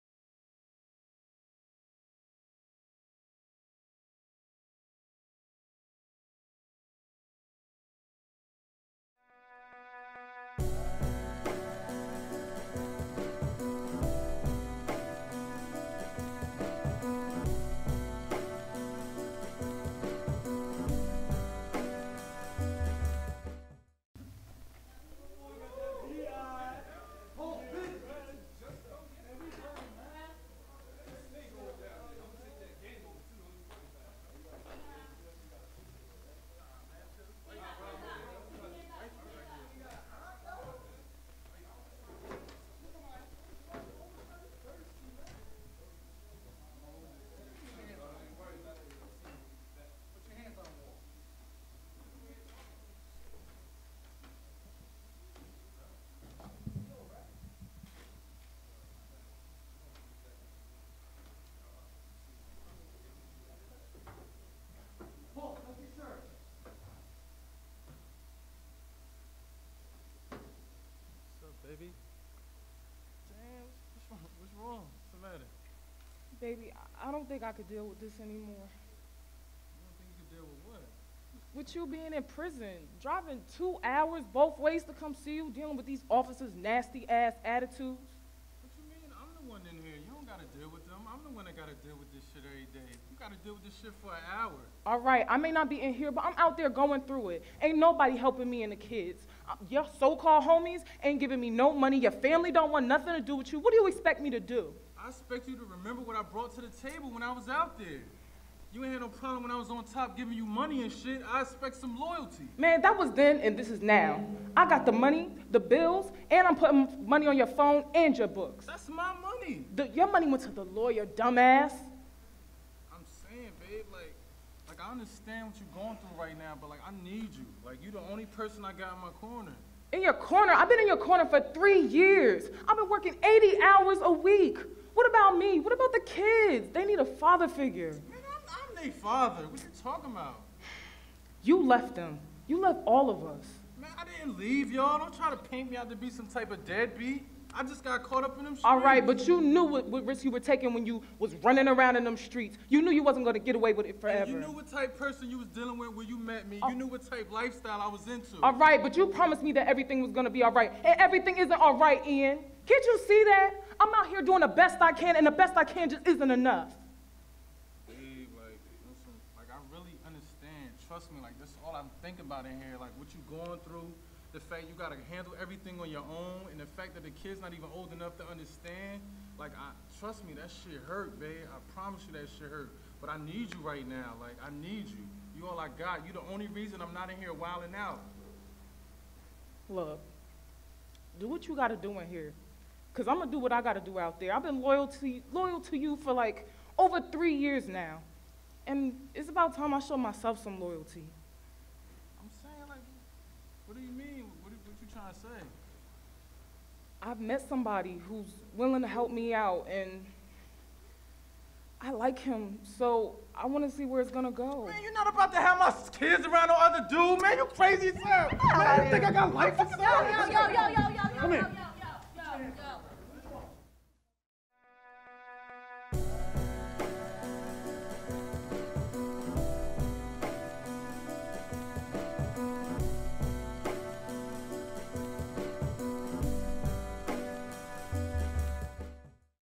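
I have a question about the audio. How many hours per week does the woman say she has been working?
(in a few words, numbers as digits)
80.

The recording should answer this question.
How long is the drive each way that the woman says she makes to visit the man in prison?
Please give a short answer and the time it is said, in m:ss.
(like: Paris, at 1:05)
2 hours, at 1:23.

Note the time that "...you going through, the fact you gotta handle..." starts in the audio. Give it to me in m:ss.
2:53.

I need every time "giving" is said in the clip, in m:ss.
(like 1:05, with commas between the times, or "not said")
1:41, 1:50.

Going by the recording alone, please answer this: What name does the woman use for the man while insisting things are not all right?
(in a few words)
Ean.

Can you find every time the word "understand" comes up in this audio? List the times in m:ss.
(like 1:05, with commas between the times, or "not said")
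2:04, 2:58.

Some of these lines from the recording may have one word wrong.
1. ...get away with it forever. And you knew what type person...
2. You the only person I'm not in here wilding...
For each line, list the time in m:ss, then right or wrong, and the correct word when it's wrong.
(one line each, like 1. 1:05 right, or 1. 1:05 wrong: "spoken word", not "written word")
1. 2:33 right
2. 3:06 wrong: "reason", not "person".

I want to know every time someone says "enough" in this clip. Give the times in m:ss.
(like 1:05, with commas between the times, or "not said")
2:46, 2:57.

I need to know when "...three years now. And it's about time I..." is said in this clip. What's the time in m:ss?
3:16.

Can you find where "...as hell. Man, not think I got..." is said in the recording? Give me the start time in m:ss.
3:37.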